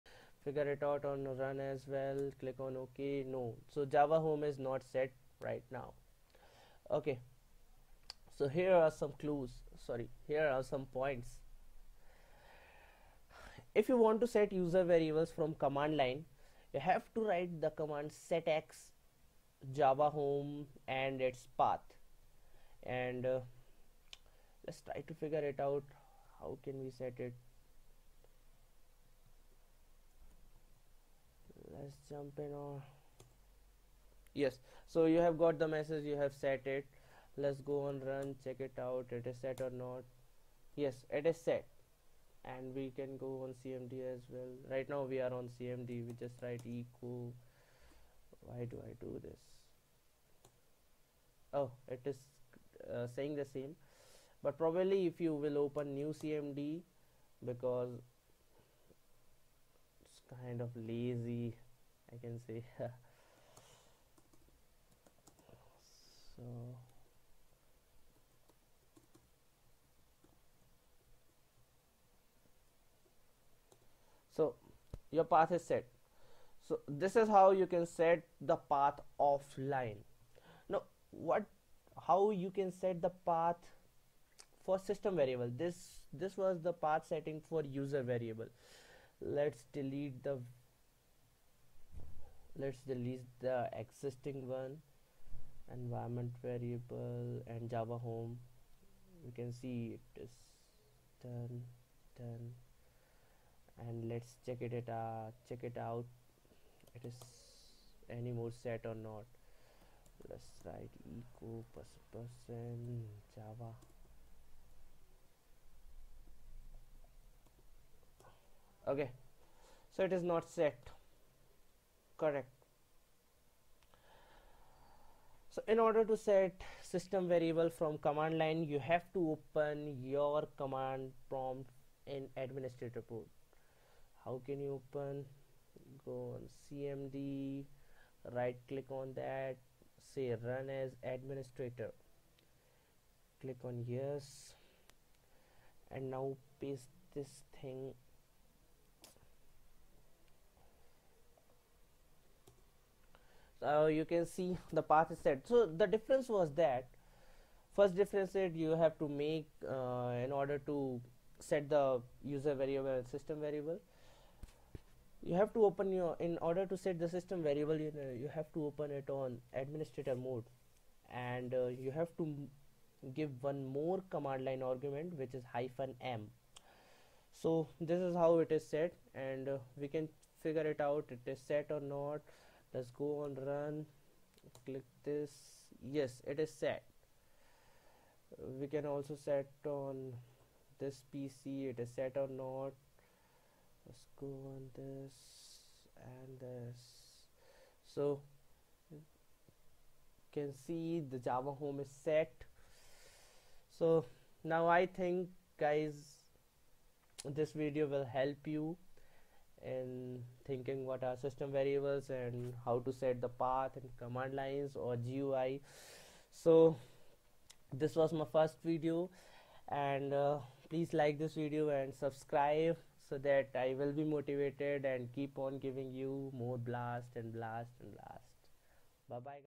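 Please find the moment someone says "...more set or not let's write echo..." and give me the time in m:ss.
1:48.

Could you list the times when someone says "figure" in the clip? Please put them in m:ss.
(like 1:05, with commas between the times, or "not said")
0:00, 0:25, 3:00.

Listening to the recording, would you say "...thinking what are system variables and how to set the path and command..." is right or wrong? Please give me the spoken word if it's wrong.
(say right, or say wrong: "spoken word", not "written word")
right.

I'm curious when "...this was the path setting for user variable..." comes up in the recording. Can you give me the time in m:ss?
1:26.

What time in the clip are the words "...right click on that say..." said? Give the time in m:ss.
2:18.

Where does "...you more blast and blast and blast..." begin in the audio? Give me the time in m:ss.
3:45.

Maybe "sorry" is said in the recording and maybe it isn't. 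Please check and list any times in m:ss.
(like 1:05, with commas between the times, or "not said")
0:09.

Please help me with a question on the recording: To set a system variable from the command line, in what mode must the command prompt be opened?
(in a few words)
administrator mode.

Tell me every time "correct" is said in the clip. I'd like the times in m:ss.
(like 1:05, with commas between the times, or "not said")
2:02.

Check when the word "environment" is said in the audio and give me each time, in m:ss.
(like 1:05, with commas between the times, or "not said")
1:35.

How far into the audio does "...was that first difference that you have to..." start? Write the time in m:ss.
2:36.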